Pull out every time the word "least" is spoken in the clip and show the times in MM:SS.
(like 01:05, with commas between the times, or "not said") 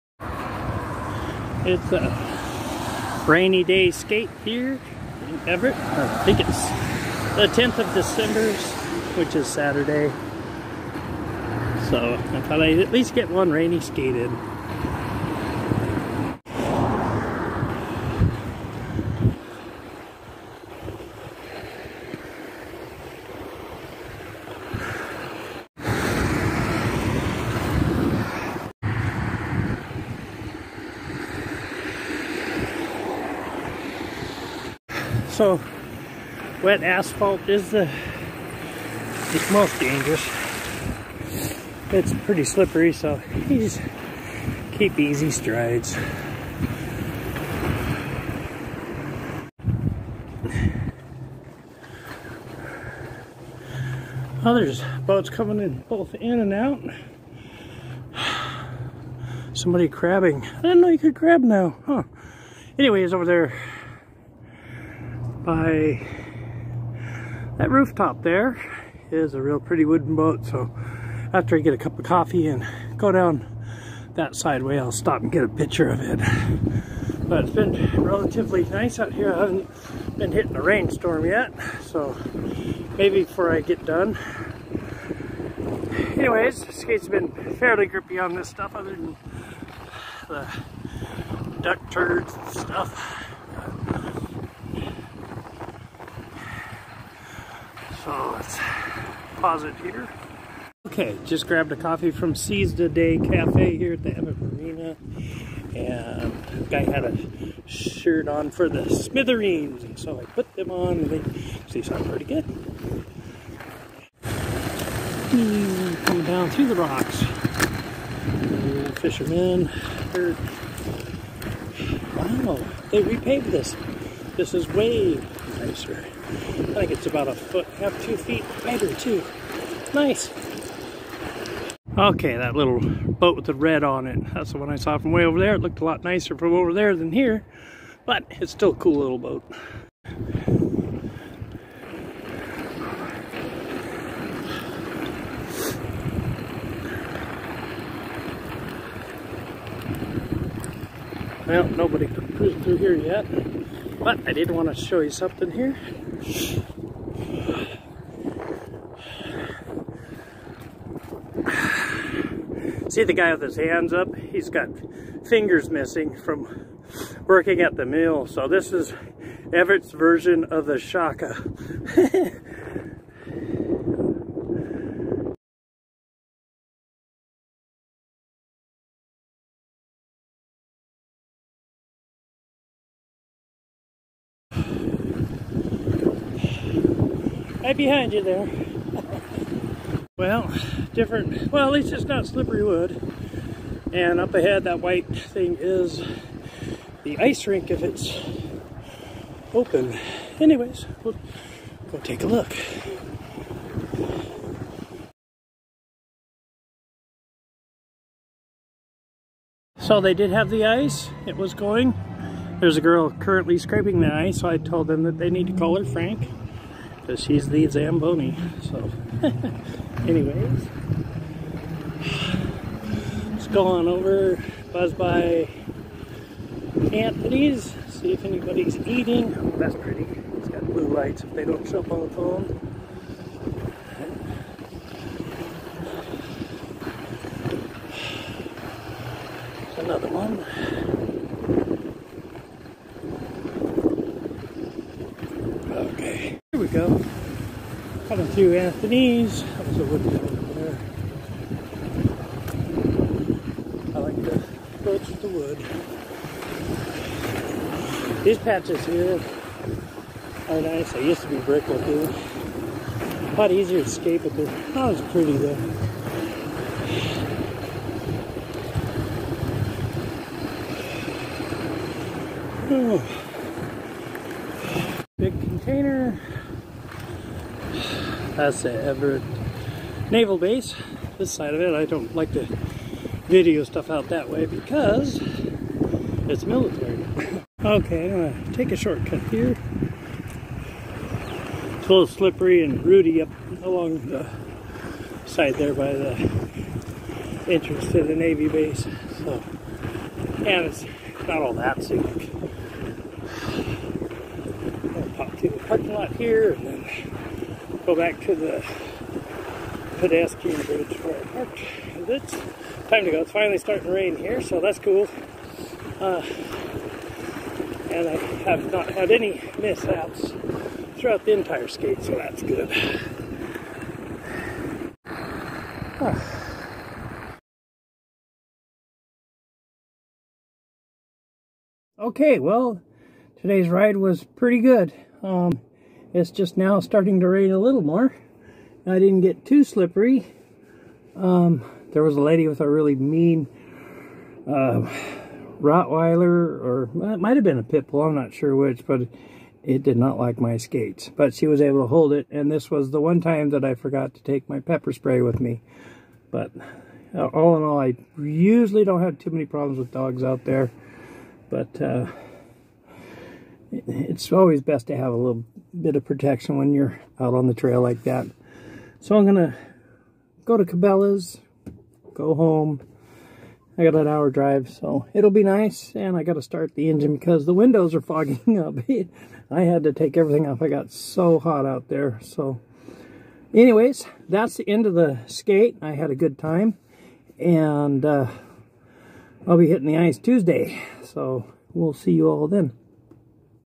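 00:12, 03:11.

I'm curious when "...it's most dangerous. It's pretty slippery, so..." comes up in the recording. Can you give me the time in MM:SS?
00:39.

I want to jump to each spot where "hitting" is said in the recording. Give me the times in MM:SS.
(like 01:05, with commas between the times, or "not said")
01:20, 06:29.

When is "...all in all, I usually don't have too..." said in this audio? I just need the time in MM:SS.
05:57.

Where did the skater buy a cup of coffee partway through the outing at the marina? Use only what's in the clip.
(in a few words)
Seize the Day Cafe.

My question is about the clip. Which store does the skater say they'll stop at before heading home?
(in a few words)
Cabela's.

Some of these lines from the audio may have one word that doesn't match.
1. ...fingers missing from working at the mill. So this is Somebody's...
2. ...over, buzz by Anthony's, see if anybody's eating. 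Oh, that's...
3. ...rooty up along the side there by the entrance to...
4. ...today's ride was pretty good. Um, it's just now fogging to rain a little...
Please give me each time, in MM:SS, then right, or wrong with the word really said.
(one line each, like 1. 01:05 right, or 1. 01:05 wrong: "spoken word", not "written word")
1. 02:45 wrong: "Everett", not "Somebody"
2. 03:43 right
3. 04:52 right
4. 05:33 wrong: "starting", not "fogging".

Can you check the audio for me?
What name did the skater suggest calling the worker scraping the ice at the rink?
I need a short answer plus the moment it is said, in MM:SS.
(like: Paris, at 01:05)
Frank, at 03:35.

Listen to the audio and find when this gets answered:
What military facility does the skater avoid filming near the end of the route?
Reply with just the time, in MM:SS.
04:38.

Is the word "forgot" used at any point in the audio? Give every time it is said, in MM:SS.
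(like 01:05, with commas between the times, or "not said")
05:53.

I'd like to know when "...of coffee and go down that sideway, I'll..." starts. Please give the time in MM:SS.
01:11.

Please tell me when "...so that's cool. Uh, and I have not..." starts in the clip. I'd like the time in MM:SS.
05:14.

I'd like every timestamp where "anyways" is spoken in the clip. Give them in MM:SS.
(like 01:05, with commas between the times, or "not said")
01:02, 01:26, 03:20, 03:40, 06:23.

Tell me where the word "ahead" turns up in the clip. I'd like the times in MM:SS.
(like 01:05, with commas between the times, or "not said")
03:14.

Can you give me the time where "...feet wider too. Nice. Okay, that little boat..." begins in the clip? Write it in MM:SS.
02:08.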